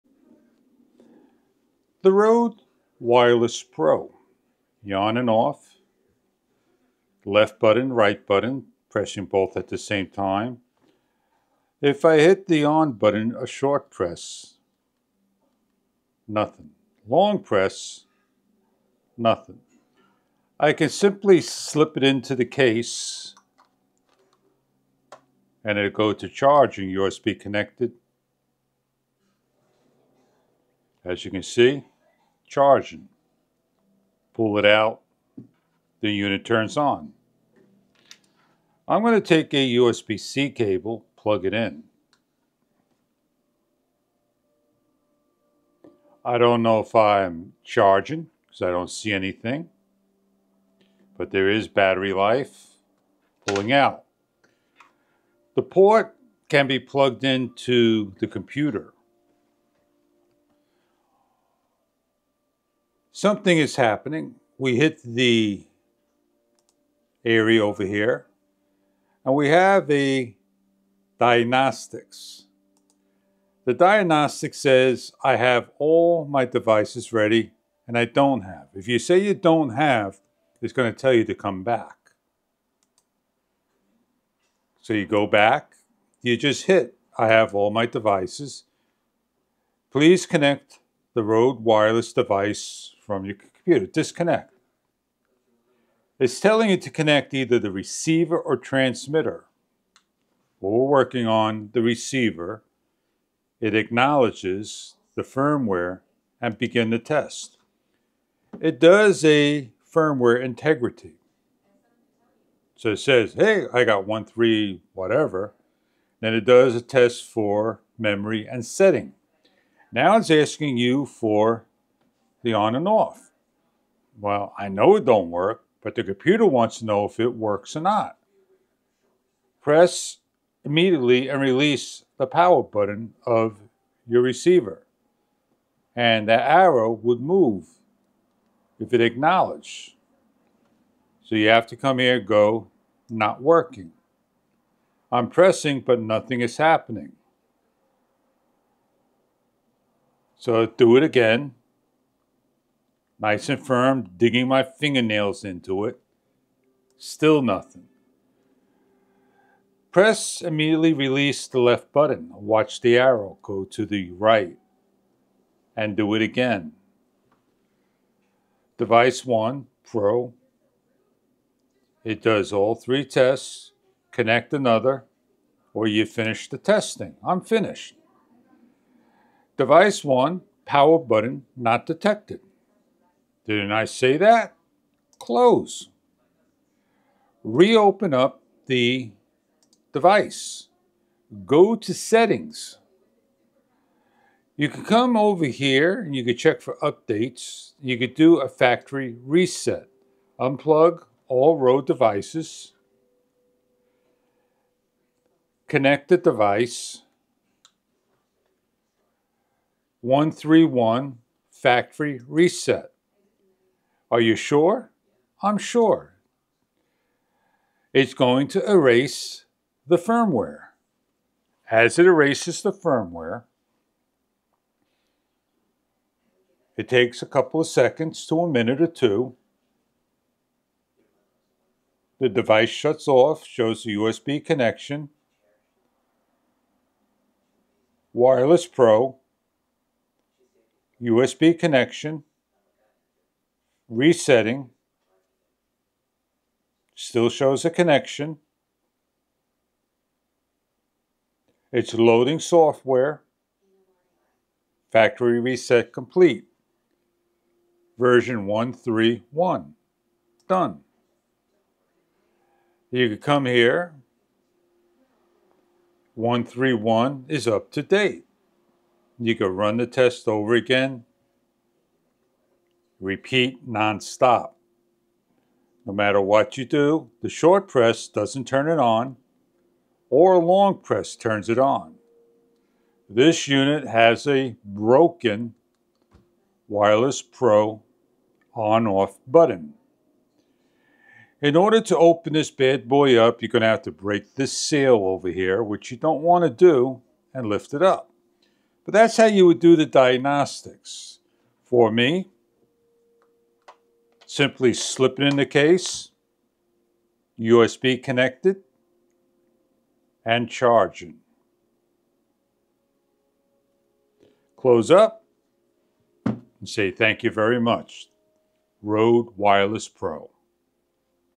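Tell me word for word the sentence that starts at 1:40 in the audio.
Well, we're working on the receiver.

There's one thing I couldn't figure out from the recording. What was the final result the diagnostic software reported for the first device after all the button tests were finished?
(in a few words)
Power button not detected.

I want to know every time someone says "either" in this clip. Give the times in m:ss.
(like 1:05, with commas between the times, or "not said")
1:37.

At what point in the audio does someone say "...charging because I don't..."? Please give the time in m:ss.
0:47.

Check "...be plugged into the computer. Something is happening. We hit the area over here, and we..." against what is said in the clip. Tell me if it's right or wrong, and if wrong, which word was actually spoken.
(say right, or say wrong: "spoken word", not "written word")
right.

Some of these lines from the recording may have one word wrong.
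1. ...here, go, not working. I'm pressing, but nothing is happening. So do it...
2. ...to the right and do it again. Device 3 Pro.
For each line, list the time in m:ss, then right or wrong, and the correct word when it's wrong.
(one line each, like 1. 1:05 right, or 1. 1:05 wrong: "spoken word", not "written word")
1. 2:21 right
2. 2:43 wrong: "1", not "3".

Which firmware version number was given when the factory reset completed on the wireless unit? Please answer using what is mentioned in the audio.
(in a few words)
131.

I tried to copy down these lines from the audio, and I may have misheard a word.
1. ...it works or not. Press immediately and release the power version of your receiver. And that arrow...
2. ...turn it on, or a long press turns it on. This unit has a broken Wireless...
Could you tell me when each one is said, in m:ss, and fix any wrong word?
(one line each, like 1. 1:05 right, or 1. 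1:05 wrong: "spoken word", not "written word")
1. 2:07 wrong: "button", not "version"
2. 4:38 right.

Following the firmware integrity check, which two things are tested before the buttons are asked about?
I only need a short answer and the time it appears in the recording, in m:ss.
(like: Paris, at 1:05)
memory and setting, at 1:57.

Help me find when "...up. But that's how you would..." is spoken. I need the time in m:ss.
4:57.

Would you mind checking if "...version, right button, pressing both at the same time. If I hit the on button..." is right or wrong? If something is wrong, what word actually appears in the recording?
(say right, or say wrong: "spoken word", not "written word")
wrong: "button", not "version".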